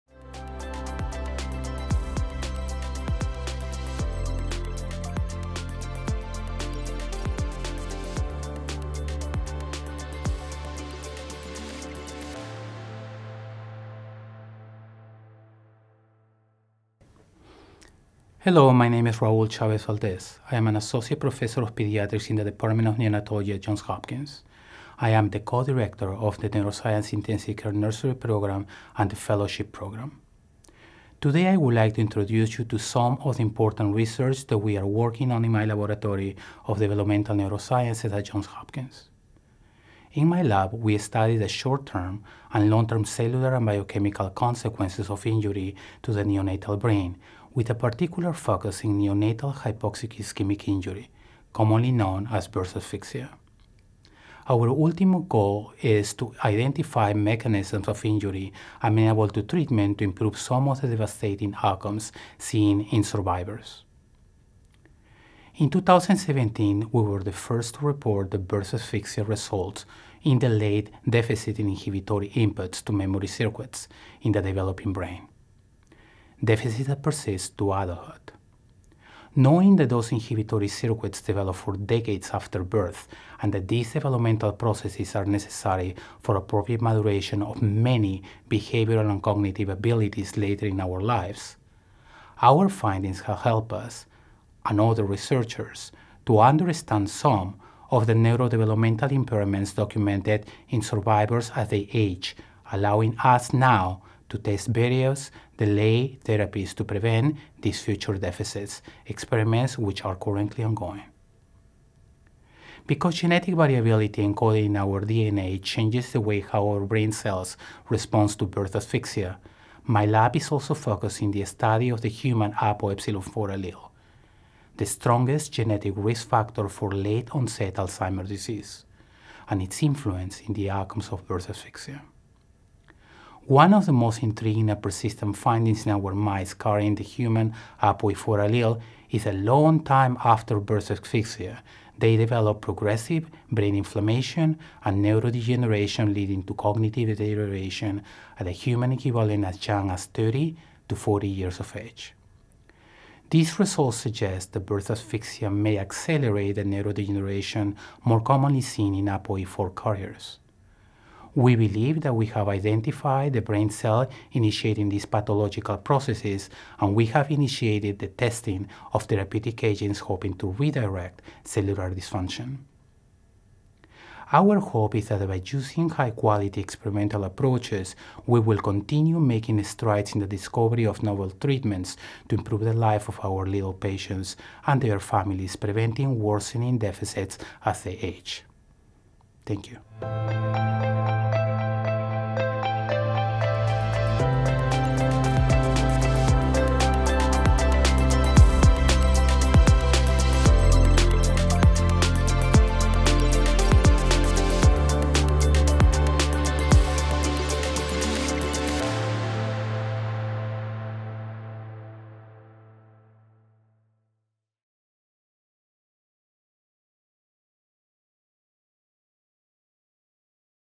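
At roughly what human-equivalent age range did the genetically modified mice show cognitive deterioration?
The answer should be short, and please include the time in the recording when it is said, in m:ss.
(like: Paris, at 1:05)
30 to 40 years, at 2:30.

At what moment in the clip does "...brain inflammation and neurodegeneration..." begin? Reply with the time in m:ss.
2:23.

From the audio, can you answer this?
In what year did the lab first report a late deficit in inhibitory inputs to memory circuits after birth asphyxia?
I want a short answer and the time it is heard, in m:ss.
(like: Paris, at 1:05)
2017, at 1:05.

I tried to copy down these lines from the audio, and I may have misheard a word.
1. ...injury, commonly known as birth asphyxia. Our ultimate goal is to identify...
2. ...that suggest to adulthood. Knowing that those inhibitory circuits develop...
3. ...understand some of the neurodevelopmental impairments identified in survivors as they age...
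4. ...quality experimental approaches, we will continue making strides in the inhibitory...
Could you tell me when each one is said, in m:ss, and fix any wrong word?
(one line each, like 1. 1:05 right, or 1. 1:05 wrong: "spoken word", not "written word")
1. 0:50 right
2. 1:16 wrong: "persist", not "suggest"
3. 1:36 wrong: "documented", not "identified"
4. 2:56 wrong: "discovery", not "inhibitory".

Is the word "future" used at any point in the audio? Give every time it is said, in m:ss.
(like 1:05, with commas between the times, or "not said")
1:47.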